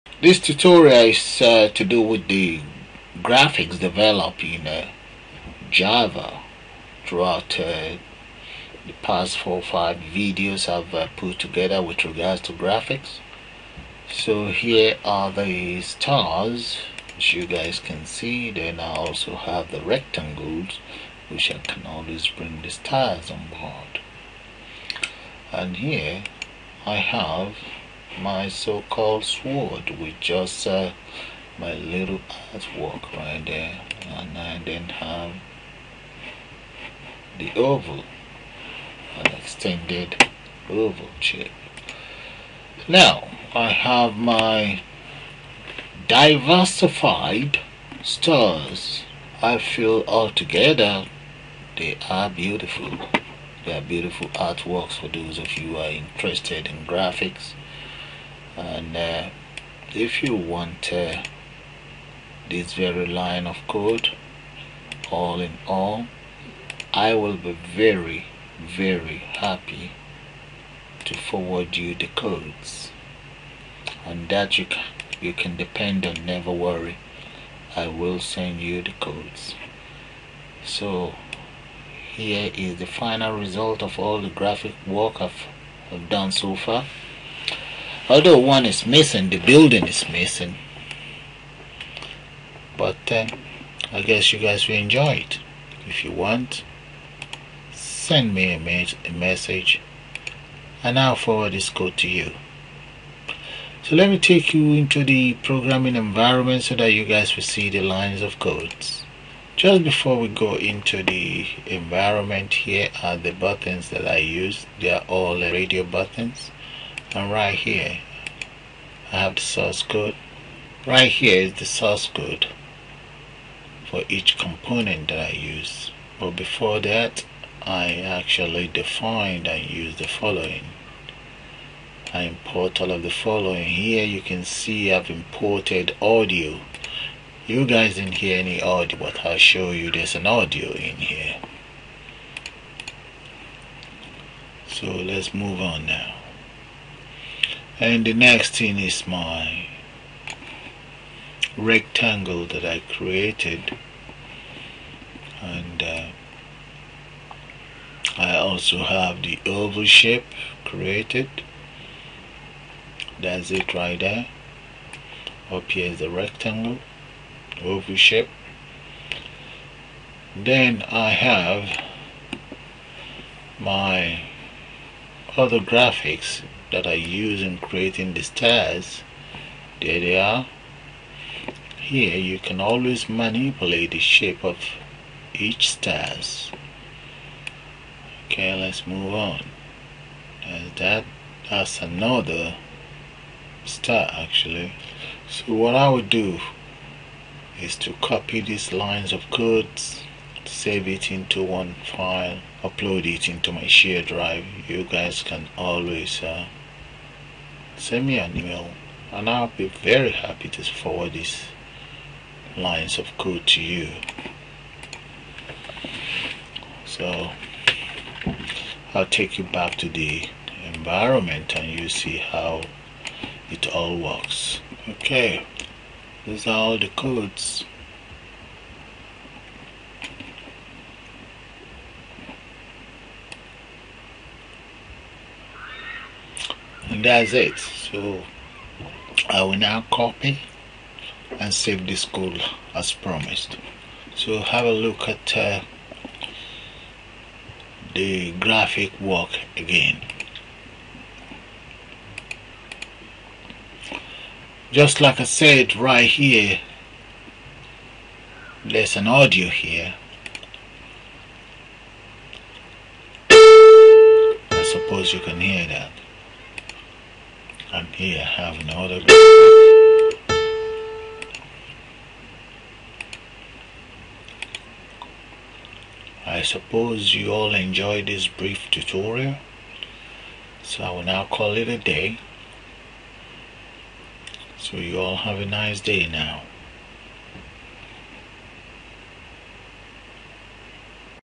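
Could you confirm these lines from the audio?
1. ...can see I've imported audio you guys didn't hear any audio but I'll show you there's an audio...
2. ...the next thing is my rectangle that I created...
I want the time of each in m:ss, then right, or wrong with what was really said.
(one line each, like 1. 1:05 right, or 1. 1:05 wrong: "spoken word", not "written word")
1. 2:14 right
2. 2:28 right.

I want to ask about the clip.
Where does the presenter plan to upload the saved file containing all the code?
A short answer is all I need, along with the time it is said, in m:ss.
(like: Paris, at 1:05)
Share drive, at 3:23.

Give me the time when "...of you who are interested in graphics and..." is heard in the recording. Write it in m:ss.
0:55.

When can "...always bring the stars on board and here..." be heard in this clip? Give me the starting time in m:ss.
0:21.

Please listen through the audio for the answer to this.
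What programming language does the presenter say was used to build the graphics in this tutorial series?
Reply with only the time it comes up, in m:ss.
0:05.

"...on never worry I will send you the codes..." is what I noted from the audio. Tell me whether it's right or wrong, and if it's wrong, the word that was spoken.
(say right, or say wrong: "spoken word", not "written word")
right.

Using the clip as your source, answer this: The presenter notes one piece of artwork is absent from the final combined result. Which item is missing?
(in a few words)
The building.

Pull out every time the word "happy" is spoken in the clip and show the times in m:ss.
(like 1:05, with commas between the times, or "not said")
1:09, 3:30.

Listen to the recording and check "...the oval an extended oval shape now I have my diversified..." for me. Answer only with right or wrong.
right.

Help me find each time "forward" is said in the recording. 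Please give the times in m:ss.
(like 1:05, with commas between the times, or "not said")
1:11, 1:41, 3:30.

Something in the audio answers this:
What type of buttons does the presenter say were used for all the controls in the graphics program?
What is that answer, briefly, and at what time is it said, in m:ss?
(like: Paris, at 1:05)
Radio buttons, at 1:55.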